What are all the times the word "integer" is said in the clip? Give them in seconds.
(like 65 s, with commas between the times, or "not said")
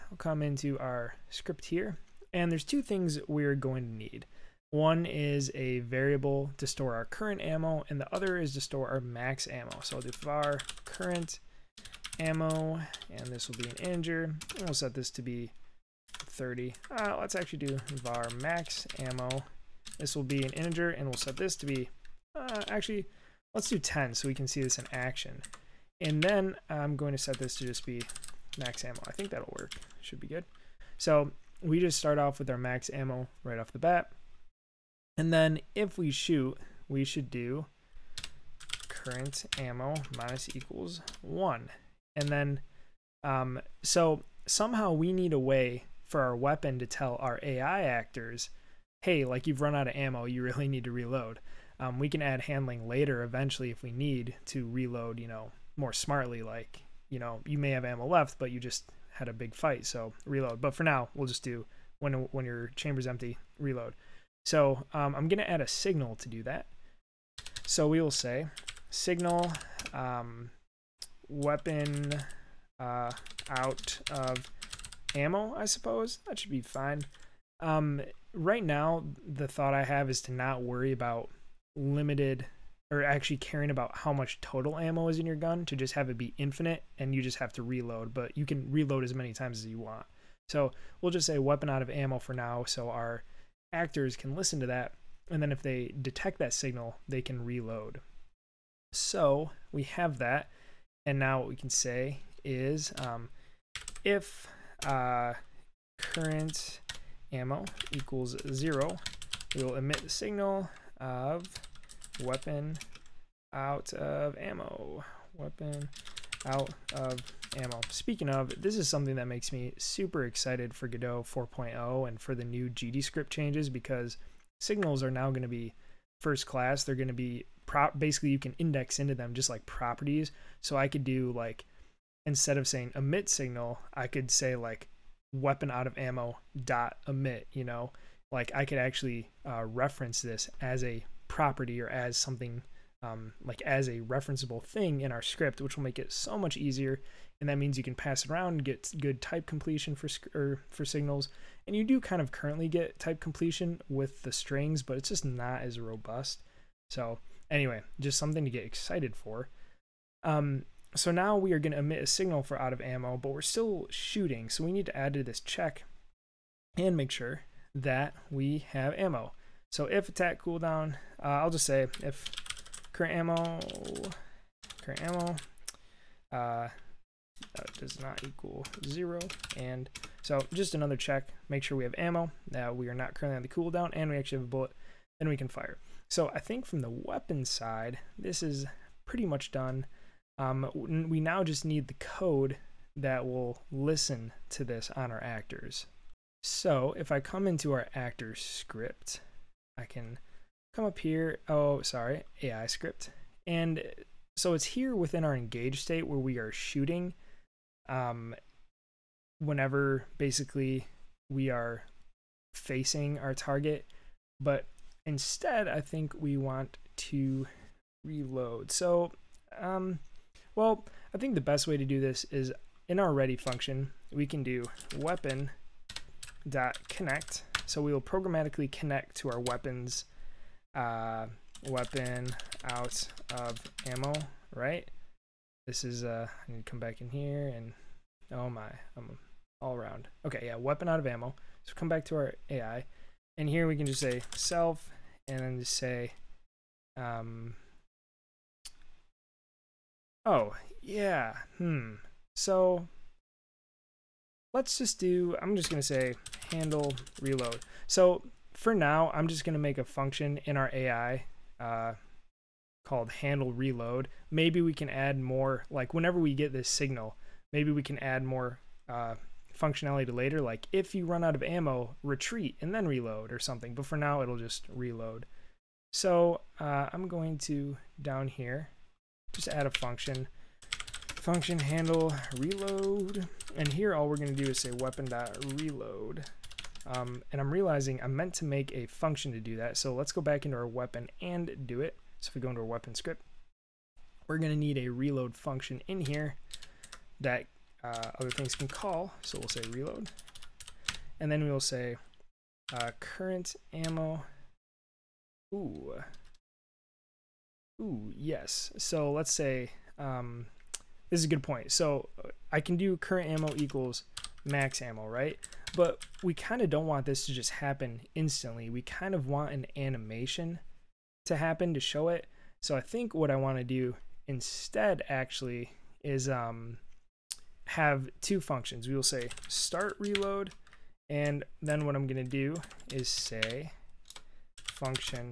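13 s, 20 s.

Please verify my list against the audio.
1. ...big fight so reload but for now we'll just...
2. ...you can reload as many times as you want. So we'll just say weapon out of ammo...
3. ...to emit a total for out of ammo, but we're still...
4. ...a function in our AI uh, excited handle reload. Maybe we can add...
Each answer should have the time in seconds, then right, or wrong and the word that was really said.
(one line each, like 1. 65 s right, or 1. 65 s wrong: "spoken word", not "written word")
1. 59 s right
2. 88 s right
3. 161 s wrong: "signal", not "total"
4. 259 s wrong: "called", not "excited".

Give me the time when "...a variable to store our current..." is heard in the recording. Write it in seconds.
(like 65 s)
5 s.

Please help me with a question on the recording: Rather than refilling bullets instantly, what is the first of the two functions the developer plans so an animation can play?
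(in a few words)
start reload.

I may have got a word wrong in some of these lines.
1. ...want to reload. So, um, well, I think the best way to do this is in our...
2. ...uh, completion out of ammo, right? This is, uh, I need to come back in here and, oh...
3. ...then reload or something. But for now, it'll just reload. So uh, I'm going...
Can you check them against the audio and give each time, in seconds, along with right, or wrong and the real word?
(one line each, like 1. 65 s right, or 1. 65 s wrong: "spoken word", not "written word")
1. 216 s right
2. 230 s wrong: "weapon", not "completion"
3. 272 s right.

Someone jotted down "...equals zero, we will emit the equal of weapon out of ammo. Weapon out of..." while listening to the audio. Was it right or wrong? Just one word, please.
wrong.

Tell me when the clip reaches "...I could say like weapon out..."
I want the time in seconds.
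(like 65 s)
133 s.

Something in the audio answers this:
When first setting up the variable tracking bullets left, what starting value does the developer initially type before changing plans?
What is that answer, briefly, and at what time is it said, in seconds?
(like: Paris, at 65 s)
30, at 16 s.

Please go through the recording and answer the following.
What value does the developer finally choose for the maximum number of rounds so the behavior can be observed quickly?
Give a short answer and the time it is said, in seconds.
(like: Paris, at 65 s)
10, at 23 s.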